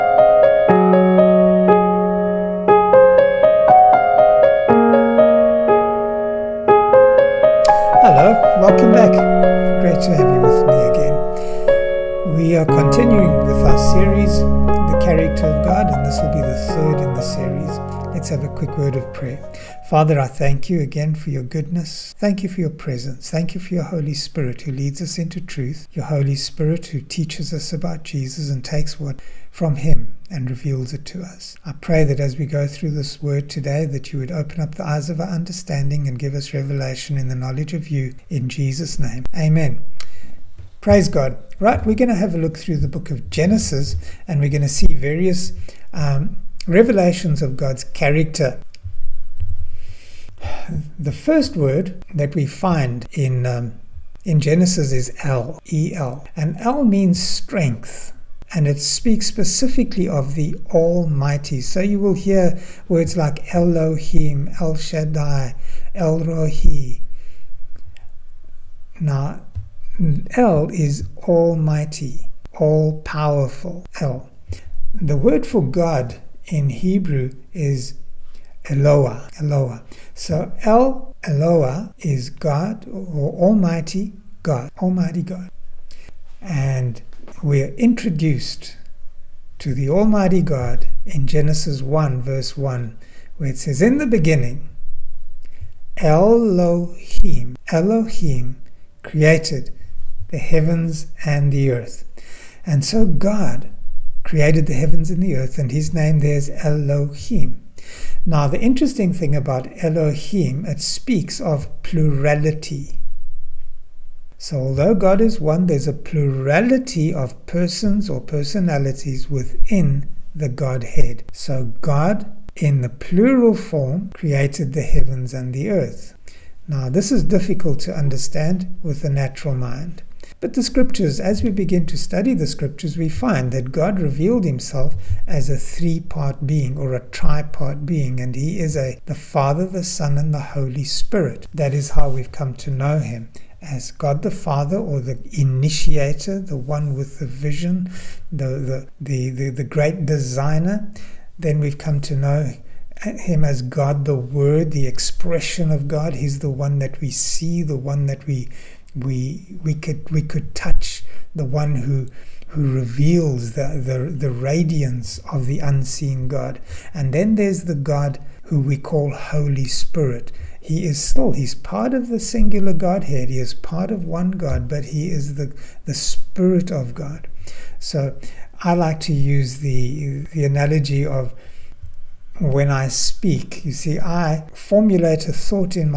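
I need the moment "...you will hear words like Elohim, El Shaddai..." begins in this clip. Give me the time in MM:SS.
01:01.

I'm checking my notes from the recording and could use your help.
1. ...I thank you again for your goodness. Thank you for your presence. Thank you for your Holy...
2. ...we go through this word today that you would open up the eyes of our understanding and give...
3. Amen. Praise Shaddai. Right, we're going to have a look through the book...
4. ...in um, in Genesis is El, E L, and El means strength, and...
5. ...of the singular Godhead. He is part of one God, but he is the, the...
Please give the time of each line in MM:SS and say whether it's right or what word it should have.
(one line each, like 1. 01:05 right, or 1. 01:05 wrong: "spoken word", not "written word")
1. 00:20 right
2. 00:32 right
3. 00:39 wrong: "God", not "Shaddai"
4. 00:53 right
5. 02:51 right.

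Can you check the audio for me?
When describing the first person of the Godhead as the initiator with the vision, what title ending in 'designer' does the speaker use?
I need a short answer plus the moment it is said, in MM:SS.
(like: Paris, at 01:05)
great designer, at 02:29.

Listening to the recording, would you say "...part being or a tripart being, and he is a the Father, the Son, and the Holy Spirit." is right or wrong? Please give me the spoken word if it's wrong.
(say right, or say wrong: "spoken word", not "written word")
right.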